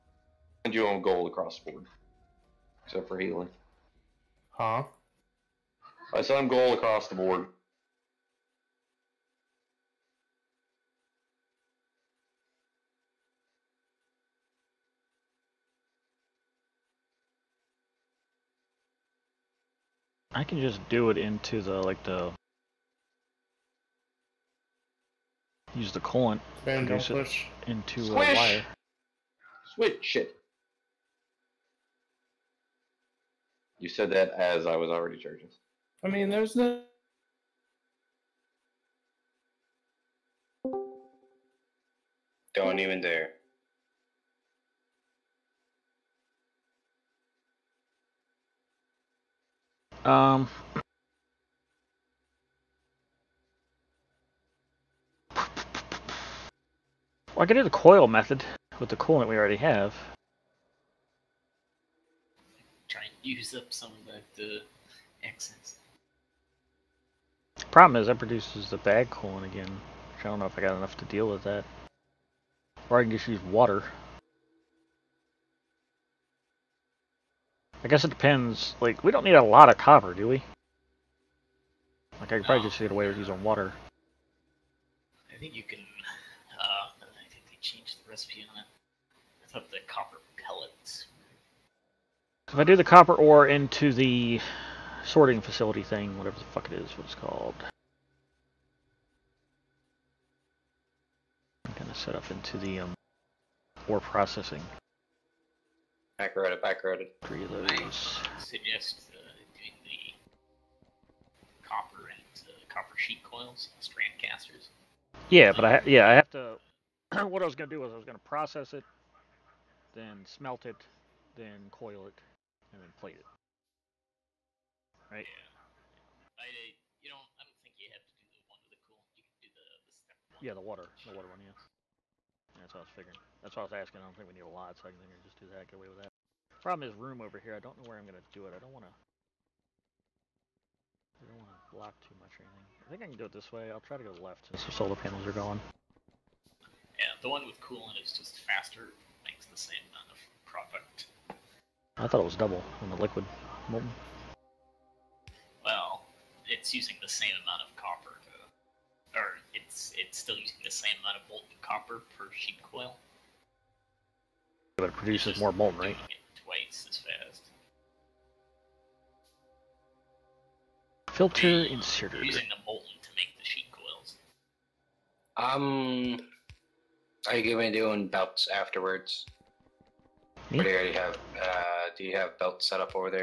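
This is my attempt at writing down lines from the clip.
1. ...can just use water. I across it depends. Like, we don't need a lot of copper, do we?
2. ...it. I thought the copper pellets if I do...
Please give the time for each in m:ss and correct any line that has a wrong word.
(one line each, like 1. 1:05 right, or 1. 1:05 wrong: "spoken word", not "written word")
1. 1:13 wrong: "guess", not "across"
2. 1:28 right.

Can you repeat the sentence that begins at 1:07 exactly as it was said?
Problem is, that produces the bag cooling again.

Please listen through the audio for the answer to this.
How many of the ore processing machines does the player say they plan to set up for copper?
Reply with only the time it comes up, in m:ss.
1:46.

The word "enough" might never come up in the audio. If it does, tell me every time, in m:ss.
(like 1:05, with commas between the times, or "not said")
1:10.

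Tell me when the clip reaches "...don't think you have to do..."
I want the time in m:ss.
2:07.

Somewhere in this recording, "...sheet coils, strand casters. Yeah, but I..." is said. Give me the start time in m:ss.
1:52.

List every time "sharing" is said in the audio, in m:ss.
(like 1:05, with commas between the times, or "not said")
not said.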